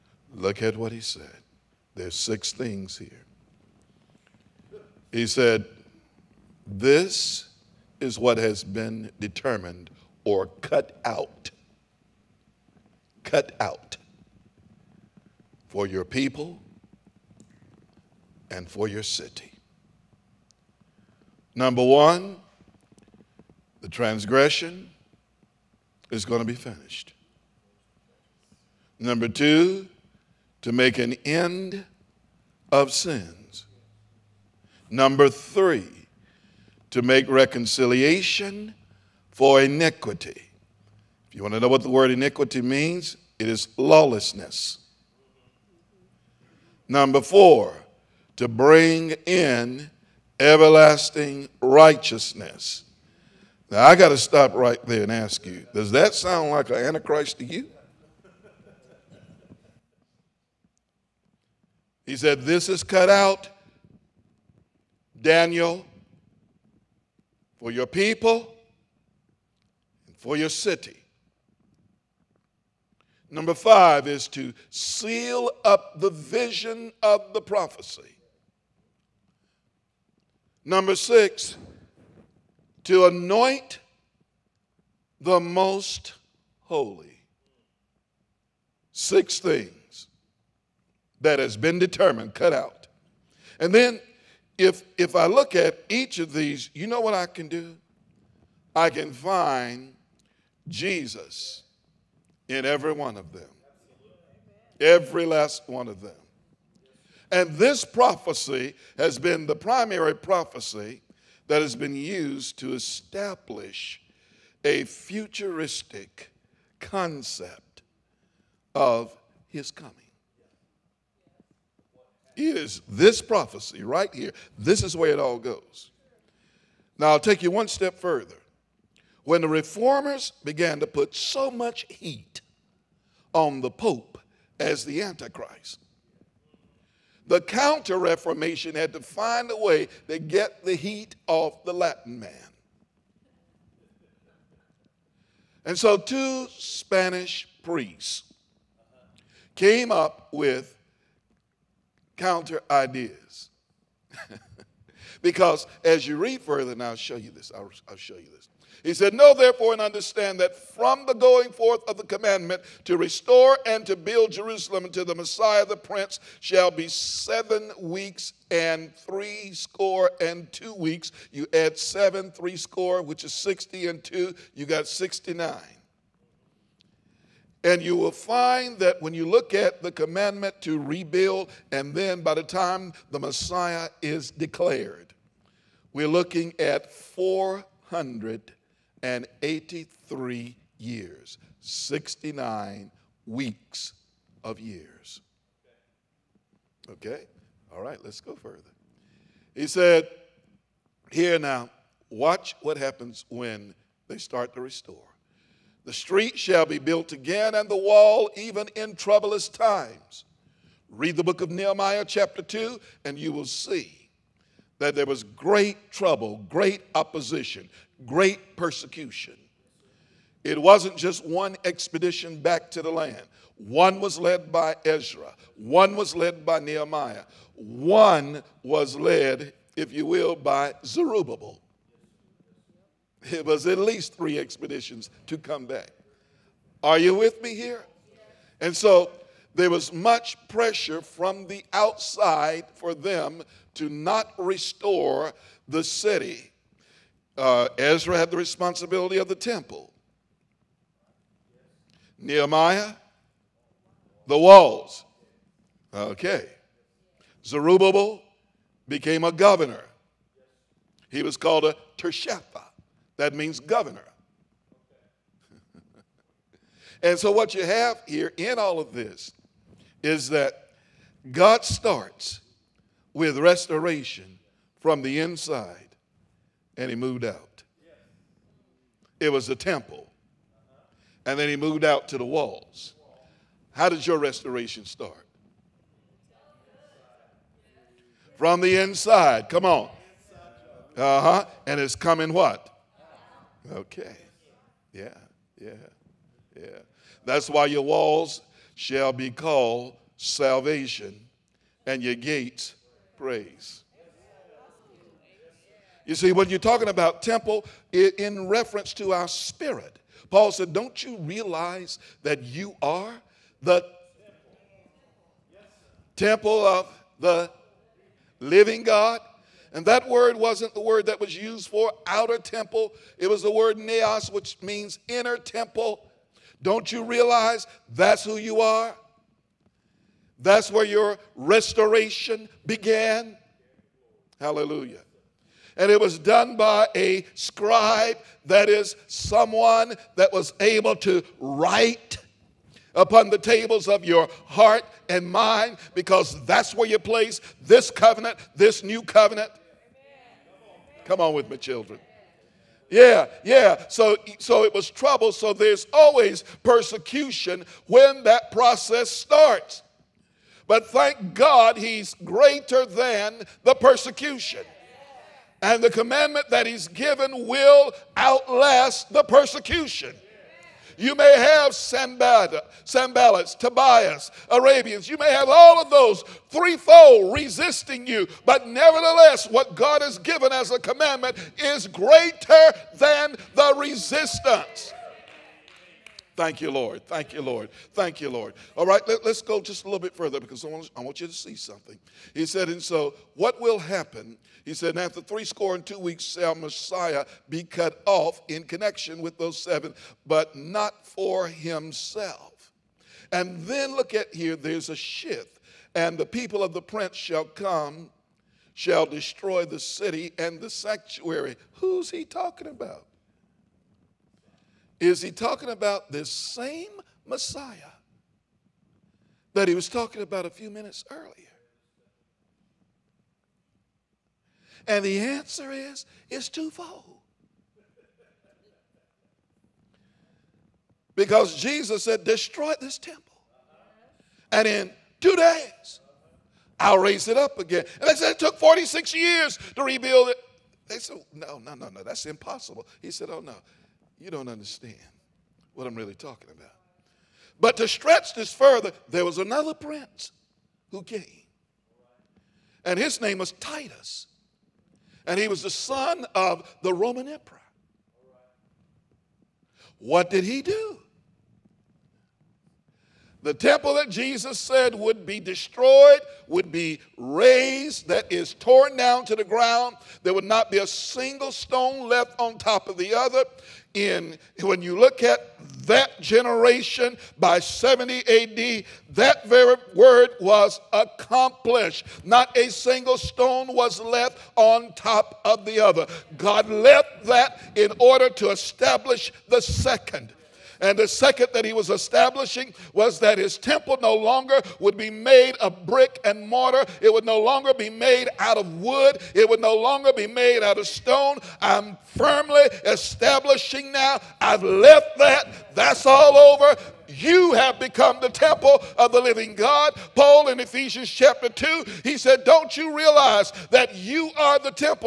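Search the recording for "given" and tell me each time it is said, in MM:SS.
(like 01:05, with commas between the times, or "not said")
06:06, 06:20.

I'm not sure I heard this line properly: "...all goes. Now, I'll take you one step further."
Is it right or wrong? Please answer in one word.
right.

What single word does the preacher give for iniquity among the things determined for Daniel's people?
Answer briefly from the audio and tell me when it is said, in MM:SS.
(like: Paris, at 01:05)
lawlessness, at 00:43.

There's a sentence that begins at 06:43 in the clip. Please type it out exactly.
And then look at here, there's a shift.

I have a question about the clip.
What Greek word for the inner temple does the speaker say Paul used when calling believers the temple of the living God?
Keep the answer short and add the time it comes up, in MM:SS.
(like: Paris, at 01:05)
neos, at 05:23.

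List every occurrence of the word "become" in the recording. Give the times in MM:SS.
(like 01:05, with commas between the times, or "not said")
08:27.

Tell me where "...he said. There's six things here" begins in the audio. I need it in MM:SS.
00:00.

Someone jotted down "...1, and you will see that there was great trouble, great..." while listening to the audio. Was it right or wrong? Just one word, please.
wrong.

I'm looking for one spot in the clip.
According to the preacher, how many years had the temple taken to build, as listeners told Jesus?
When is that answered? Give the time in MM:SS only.
07:18.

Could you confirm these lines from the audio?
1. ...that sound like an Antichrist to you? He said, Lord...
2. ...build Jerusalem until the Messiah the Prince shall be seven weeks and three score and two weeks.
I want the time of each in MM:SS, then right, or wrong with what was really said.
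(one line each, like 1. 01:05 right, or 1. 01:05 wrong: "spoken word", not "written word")
1. 00:55 wrong: "This", not "Lord"
2. 02:43 right.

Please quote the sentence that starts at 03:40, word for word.
It wasn't just one expedition back to the land.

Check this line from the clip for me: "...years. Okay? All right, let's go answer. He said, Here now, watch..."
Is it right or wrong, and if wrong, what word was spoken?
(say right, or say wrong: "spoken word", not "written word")
wrong: "further", not "answer".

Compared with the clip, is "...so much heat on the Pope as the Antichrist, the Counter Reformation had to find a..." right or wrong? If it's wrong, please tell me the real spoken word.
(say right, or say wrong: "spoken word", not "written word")
right.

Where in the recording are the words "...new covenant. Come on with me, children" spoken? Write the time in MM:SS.
05:48.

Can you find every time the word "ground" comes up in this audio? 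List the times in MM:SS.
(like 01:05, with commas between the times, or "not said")
07:49.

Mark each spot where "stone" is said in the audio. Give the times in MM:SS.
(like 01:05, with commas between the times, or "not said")
07:51, 08:03, 08:20.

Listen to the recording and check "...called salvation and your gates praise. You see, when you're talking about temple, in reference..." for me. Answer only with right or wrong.
right.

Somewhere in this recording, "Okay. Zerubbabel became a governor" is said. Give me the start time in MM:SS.
04:15.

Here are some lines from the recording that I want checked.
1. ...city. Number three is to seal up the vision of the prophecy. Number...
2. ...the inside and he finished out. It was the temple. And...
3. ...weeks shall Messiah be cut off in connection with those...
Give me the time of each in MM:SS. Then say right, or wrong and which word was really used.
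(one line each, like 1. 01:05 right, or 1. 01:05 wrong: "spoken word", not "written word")
1. 01:10 wrong: "five", not "three"
2. 04:35 wrong: "moved", not "finished"
3. 06:35 right.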